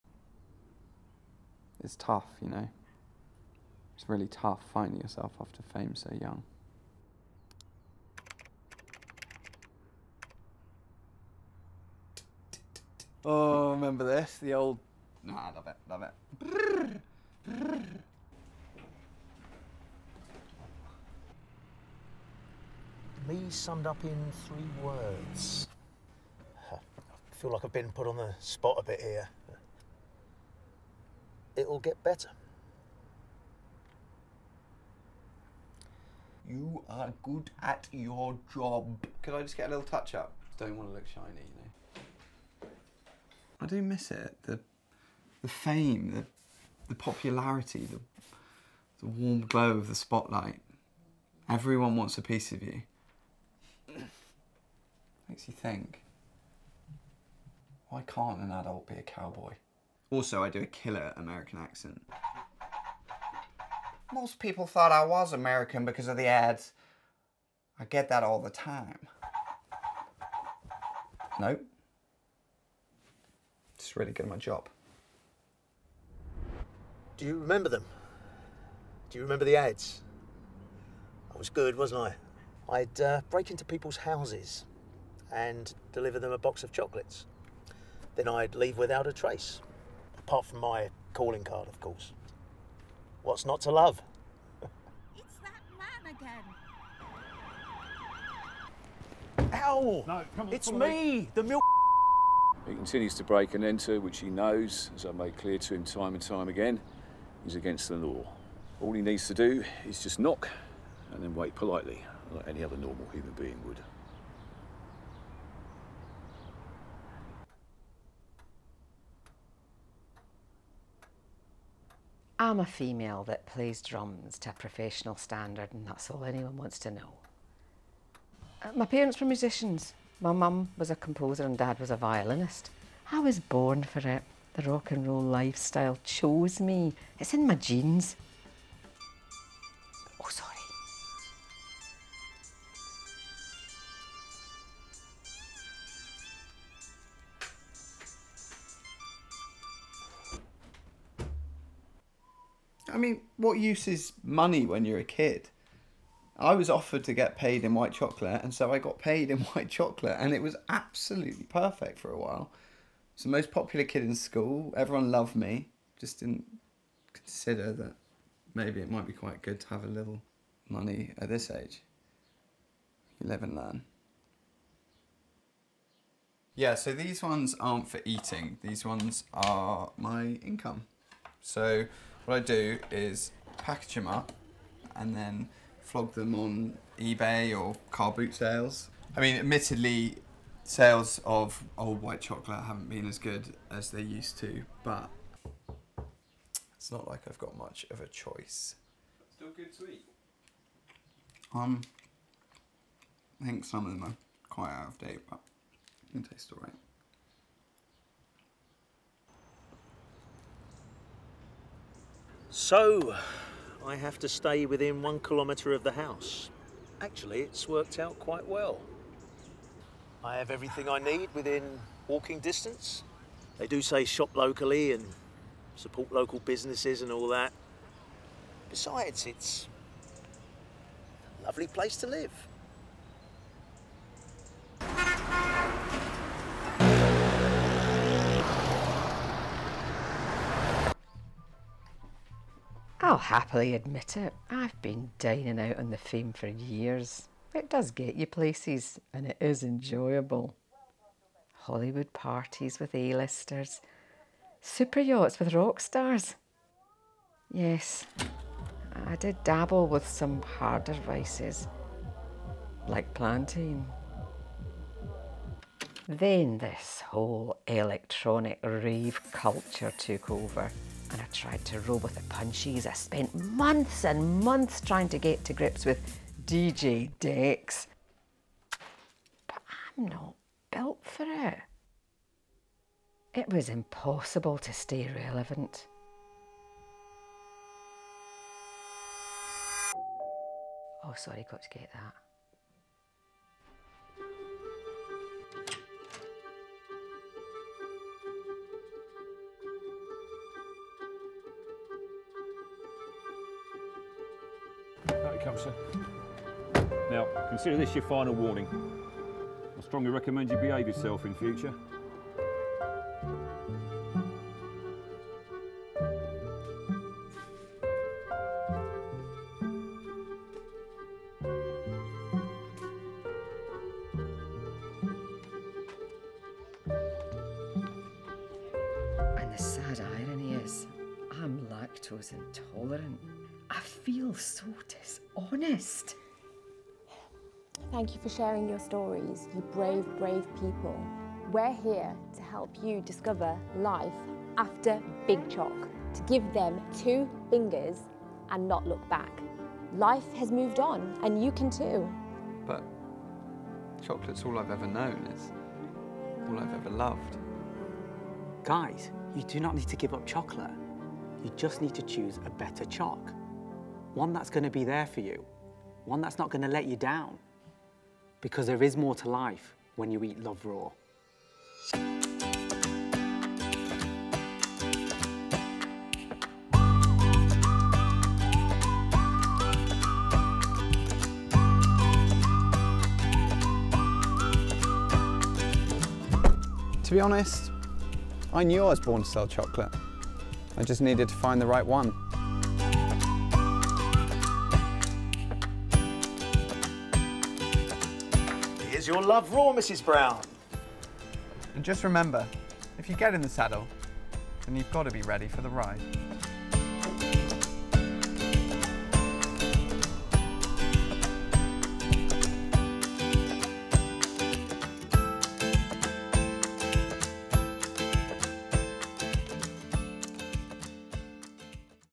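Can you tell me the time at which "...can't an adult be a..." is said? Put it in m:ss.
0:58.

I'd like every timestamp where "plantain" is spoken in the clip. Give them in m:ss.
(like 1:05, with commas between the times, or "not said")
4:23.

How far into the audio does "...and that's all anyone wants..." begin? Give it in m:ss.
2:05.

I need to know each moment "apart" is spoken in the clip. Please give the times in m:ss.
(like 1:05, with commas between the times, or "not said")
1:30.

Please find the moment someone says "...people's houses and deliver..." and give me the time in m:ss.
1:23.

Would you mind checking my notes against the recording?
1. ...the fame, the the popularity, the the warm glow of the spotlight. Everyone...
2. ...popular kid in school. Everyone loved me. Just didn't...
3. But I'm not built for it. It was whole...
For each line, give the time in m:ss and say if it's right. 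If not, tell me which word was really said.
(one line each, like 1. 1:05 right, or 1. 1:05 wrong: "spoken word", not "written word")
1. 0:45 right
2. 2:43 right
3. 4:39 wrong: "impossible", not "whole".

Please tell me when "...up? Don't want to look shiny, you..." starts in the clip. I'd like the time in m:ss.
0:40.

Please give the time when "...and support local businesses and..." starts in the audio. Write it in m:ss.
3:44.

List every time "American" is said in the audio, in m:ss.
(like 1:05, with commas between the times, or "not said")
1:01, 1:05.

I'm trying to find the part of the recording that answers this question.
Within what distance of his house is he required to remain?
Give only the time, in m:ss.
3:35.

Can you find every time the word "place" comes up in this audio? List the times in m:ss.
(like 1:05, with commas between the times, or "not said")
3:51, 4:08.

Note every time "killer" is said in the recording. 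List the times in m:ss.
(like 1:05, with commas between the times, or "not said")
1:00.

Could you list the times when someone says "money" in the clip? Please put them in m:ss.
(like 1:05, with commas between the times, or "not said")
2:34, 2:50.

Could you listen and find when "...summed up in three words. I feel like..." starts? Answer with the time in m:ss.
0:23.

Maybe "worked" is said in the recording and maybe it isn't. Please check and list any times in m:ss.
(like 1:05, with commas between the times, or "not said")
3:37.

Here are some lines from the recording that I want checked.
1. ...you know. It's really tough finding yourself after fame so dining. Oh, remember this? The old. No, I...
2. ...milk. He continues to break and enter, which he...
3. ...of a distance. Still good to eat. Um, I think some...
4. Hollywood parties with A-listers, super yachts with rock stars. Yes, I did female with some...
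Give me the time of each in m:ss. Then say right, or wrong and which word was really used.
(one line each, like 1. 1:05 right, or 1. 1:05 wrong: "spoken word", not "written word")
1. 0:02 wrong: "young", not "dining"
2. 1:41 right
3. 3:17 wrong: "choice", not "distance"
4. 4:11 wrong: "dabble", not "female".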